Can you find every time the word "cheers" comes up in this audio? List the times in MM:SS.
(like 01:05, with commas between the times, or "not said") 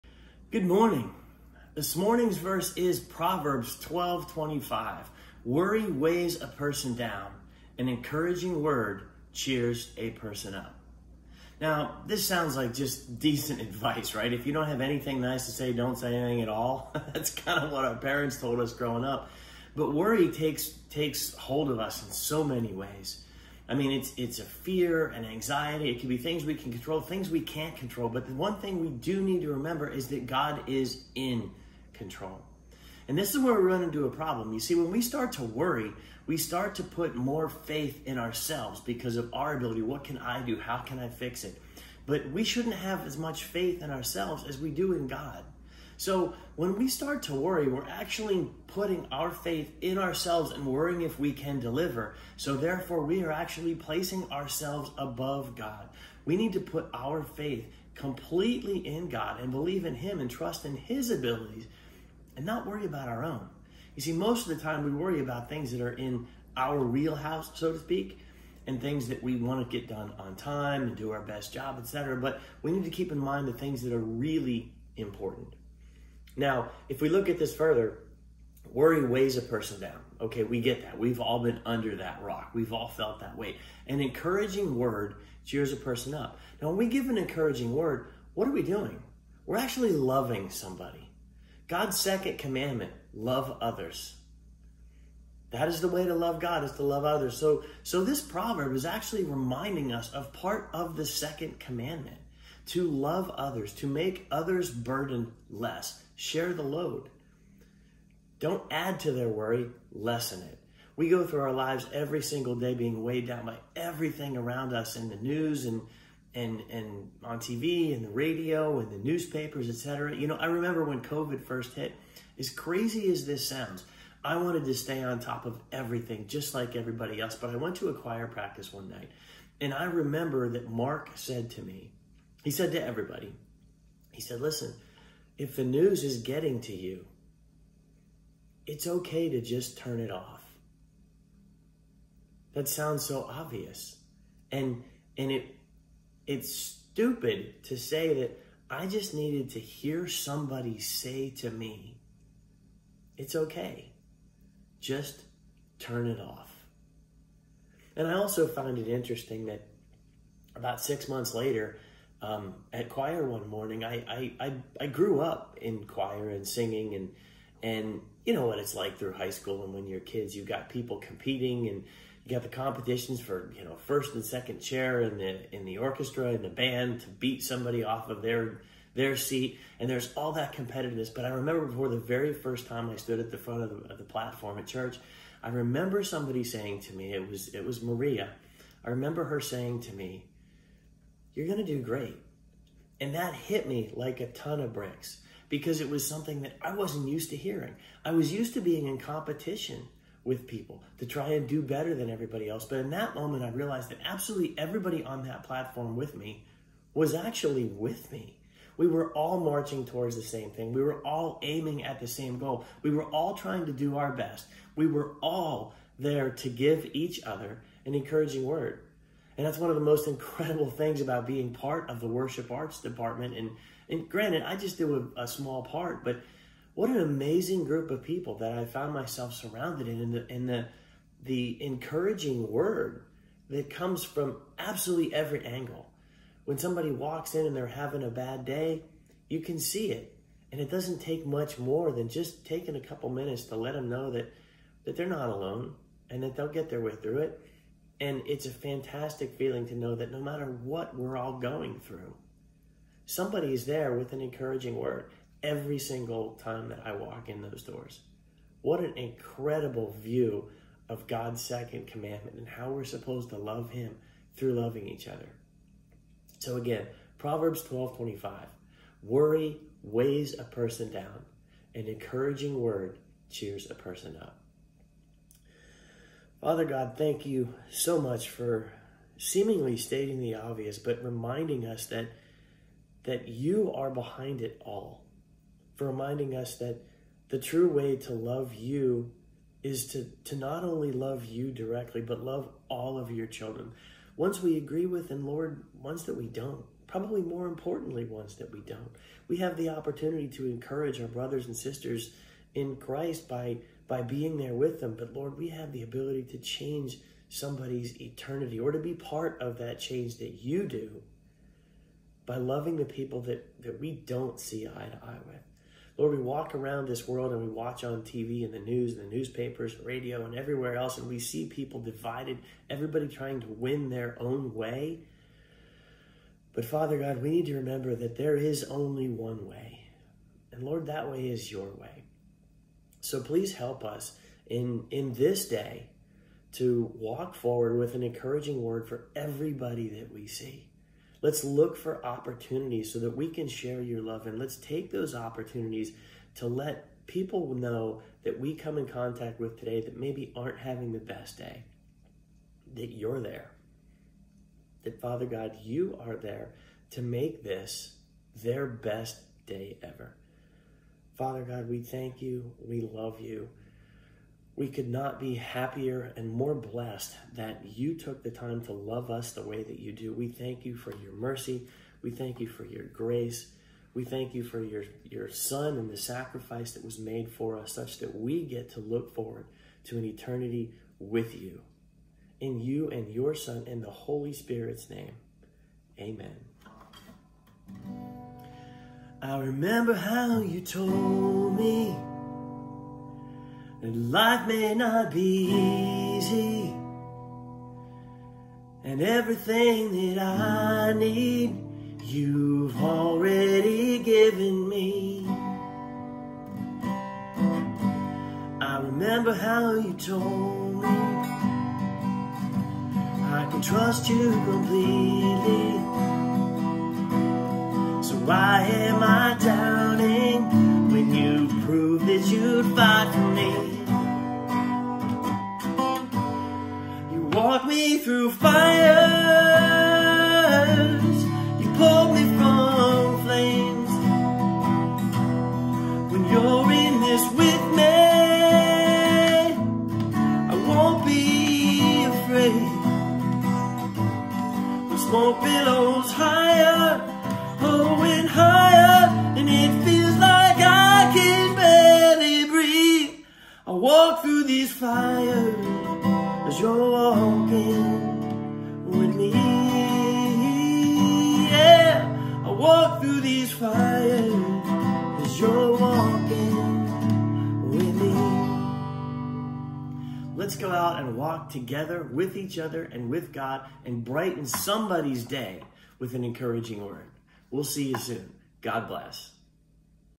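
00:09, 01:25, 04:33.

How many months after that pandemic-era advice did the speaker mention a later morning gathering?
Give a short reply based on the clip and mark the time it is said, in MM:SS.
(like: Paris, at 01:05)
6, at 02:40.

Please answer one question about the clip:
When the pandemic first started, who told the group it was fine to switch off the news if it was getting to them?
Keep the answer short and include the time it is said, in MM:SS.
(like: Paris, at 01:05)
Mark, at 02:10.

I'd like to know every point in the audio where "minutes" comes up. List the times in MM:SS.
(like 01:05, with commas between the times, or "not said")
04:03.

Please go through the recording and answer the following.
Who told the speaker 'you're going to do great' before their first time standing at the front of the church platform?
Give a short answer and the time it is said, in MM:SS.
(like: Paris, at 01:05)
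Maria, at 03:07.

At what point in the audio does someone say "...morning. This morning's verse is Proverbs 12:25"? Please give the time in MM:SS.
00:00.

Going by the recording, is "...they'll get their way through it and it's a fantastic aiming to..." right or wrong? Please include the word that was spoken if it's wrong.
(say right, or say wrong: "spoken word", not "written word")
wrong: "feeling", not "aiming".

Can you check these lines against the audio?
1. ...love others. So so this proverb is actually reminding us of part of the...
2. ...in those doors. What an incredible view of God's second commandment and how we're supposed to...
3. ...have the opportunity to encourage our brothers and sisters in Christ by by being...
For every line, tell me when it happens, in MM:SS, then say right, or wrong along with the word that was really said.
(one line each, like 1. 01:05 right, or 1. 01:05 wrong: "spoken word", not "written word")
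1. 01:36 right
2. 04:17 right
3. 04:59 right.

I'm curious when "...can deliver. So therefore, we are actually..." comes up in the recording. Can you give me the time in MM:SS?
00:51.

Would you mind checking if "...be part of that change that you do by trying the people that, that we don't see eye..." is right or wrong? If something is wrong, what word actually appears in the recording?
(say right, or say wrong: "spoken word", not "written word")
wrong: "loving", not "trying".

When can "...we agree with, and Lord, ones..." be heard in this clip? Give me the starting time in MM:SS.
04:54.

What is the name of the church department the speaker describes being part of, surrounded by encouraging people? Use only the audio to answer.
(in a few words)
worship arts department.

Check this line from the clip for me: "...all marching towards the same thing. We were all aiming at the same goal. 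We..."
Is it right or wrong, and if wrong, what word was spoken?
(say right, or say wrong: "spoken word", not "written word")
right.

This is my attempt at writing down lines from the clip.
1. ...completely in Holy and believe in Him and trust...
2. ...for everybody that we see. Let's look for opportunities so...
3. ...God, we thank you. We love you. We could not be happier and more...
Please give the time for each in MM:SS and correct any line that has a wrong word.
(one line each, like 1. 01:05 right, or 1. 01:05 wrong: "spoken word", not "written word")
1. 00:57 wrong: "God", not "Holy"
2. 05:38 right
3. 06:01 right.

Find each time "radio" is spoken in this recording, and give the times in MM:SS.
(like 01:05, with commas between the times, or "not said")
01:58, 05:19.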